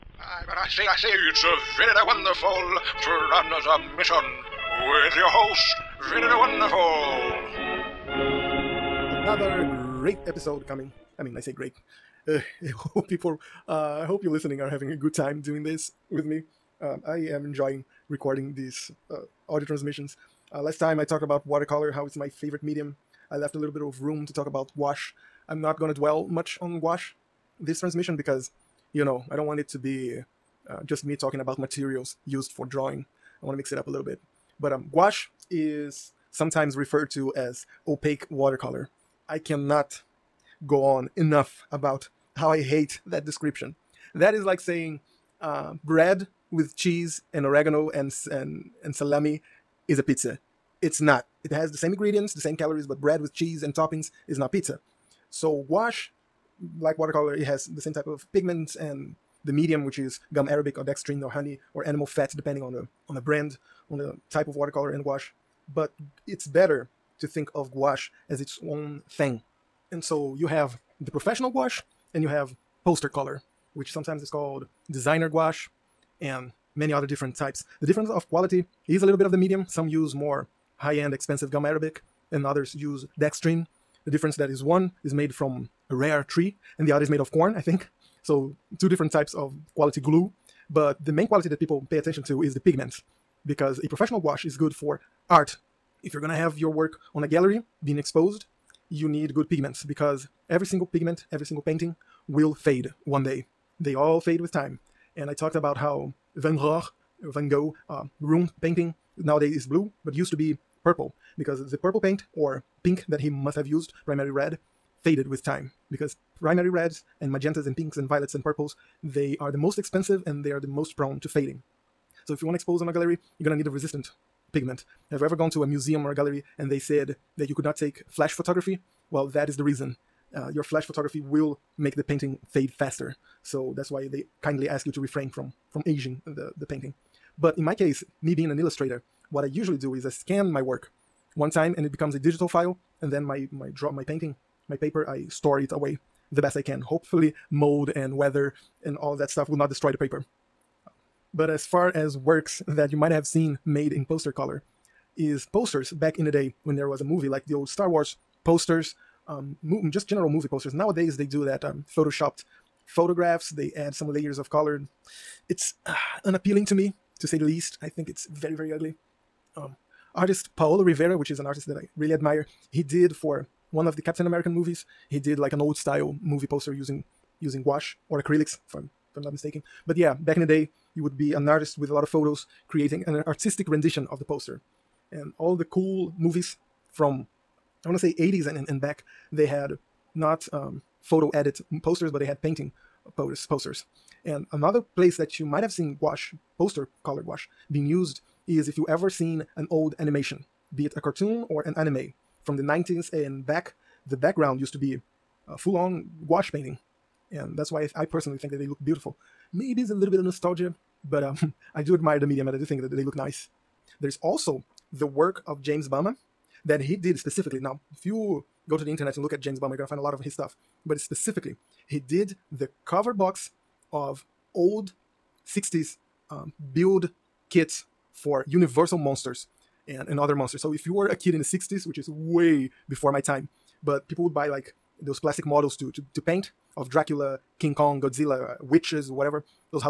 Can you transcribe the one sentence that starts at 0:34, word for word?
But um, gouache is sometimes referred to as opaque watercolor.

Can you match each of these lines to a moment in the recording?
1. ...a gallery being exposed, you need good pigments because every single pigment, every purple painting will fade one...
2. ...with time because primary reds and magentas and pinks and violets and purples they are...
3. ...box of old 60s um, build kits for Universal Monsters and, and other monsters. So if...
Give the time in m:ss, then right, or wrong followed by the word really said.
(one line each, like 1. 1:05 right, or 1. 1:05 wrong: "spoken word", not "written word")
1. 1:37 wrong: "single", not "purple"
2. 1:55 right
3. 3:43 right.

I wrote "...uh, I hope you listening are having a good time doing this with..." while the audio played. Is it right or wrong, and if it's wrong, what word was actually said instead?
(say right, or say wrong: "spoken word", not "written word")
right.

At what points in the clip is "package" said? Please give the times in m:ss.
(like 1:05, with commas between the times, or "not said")
not said.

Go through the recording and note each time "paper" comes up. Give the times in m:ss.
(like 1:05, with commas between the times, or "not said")
2:24, 2:29.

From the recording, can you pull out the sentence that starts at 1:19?
Some use more high-end expensive gum arabic and others use dextrin.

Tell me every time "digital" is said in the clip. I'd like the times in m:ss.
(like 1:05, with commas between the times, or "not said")
2:22.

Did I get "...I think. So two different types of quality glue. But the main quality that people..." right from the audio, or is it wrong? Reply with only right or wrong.
right.